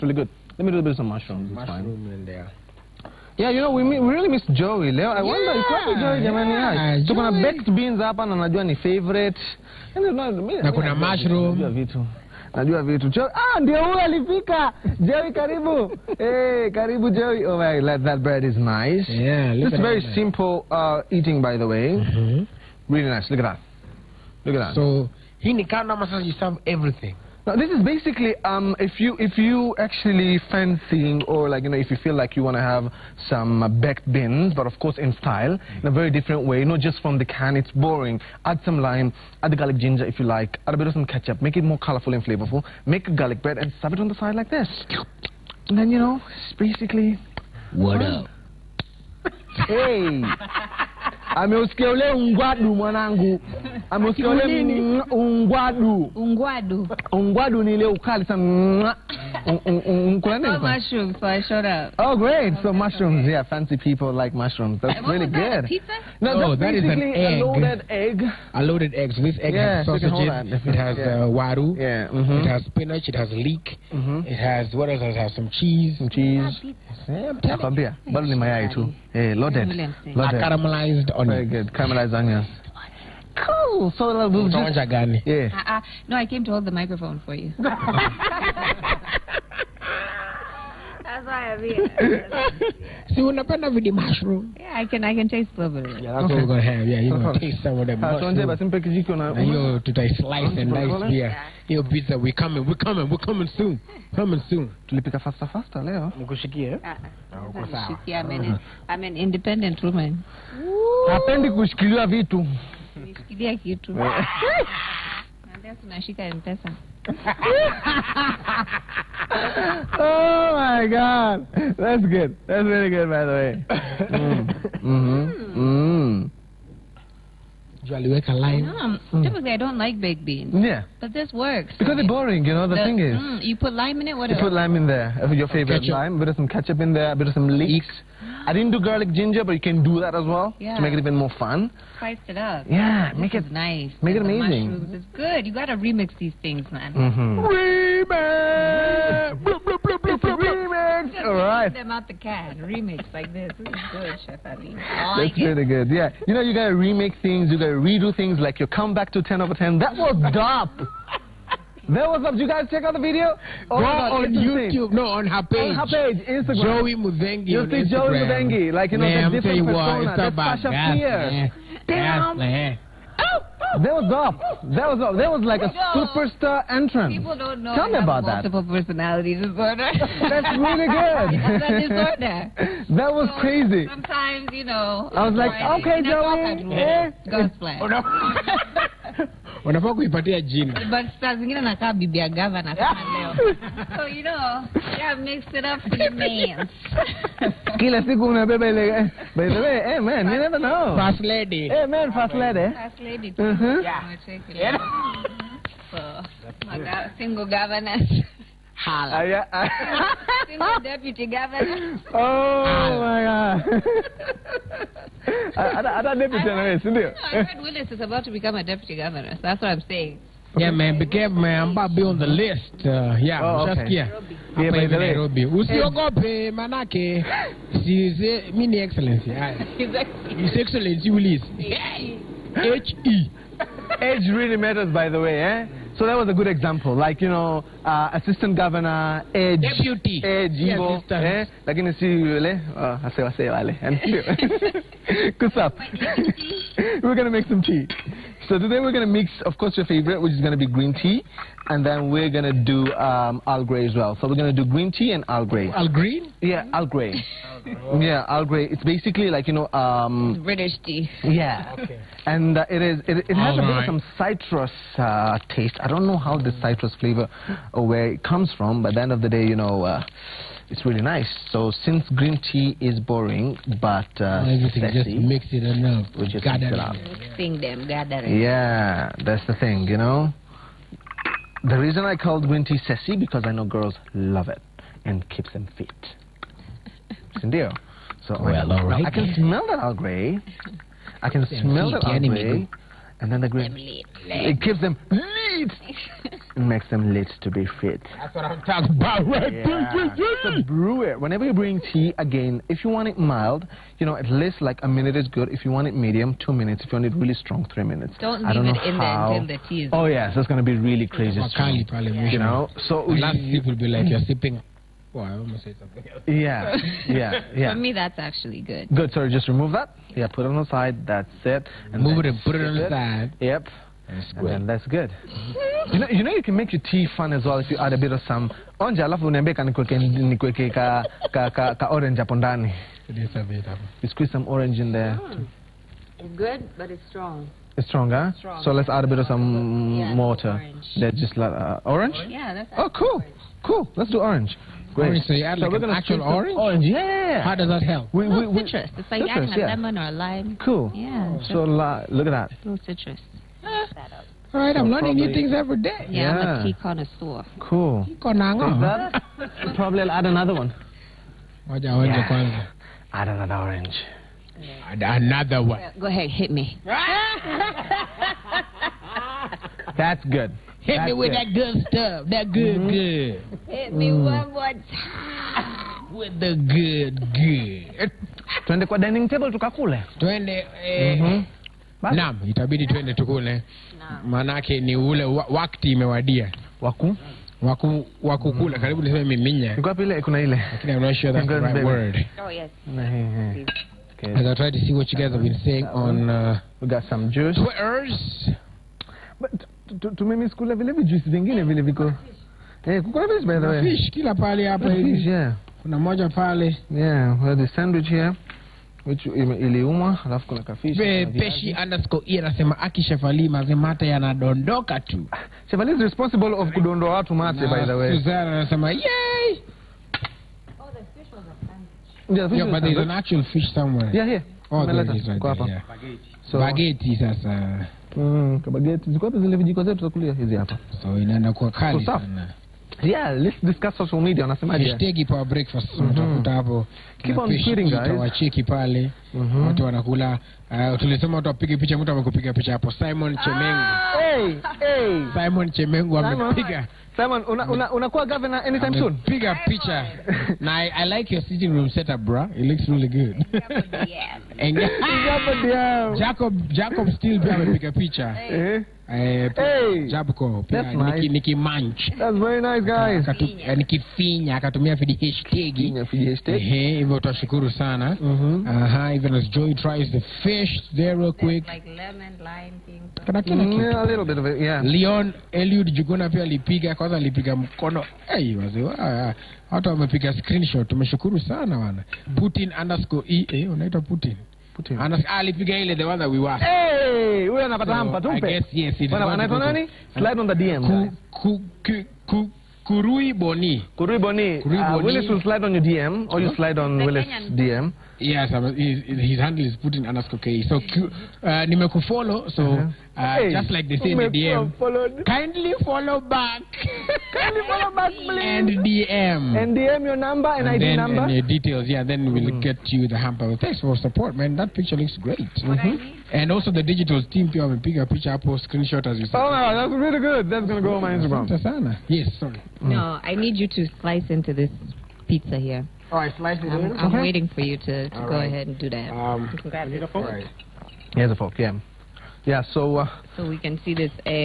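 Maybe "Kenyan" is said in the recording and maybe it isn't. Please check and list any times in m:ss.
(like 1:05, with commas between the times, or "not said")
8:17.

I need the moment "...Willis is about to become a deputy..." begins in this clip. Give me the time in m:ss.
3:37.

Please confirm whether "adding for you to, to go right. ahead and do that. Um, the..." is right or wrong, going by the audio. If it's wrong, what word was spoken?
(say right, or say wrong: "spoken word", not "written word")
wrong: "waiting", not "adding".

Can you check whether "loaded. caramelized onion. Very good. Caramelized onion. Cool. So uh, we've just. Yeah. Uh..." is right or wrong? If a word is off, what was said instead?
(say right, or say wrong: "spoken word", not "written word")
right.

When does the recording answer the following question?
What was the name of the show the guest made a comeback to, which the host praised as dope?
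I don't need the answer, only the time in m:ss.
2:39.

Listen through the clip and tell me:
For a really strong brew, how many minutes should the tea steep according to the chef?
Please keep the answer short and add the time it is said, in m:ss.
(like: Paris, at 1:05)
3 minutes, at 5:07.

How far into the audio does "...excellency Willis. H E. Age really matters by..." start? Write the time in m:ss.
3:50.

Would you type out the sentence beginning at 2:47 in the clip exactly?
Joey Muthengi Like, you know, man, the different persona.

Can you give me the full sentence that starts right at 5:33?
Um, you squeeze some orange in there.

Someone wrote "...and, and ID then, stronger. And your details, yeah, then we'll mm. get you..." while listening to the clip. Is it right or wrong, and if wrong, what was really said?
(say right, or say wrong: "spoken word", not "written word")
wrong: "number", not "stronger".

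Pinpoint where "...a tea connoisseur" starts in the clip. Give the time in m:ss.
5:56.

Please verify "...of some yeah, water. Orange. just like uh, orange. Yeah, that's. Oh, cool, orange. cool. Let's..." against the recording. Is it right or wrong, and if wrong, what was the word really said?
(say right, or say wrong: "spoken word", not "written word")
right.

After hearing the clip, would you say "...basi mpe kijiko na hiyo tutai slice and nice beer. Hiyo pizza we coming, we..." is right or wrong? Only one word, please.
right.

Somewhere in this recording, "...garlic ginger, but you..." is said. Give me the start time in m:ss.
2:18.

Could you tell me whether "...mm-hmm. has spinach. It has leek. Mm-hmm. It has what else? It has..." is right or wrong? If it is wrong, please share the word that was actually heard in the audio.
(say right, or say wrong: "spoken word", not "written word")
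right.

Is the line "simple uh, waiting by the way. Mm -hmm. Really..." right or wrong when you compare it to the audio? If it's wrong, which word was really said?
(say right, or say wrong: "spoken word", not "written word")
wrong: "eating", not "waiting".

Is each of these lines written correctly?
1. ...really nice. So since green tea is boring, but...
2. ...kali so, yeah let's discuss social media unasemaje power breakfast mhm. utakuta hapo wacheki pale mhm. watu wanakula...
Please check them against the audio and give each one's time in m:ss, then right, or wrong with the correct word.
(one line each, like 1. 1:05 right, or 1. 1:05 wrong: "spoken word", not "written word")
1. 4:30 right
2. 7:11 right.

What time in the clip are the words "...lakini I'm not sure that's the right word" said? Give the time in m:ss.
6:30.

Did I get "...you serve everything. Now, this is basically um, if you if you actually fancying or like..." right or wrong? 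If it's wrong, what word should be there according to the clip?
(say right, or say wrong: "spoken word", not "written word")
right.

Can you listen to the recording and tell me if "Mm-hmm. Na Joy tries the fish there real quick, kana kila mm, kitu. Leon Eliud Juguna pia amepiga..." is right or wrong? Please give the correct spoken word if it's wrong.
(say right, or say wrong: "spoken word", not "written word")
wrong: "alipiga", not "amepiga".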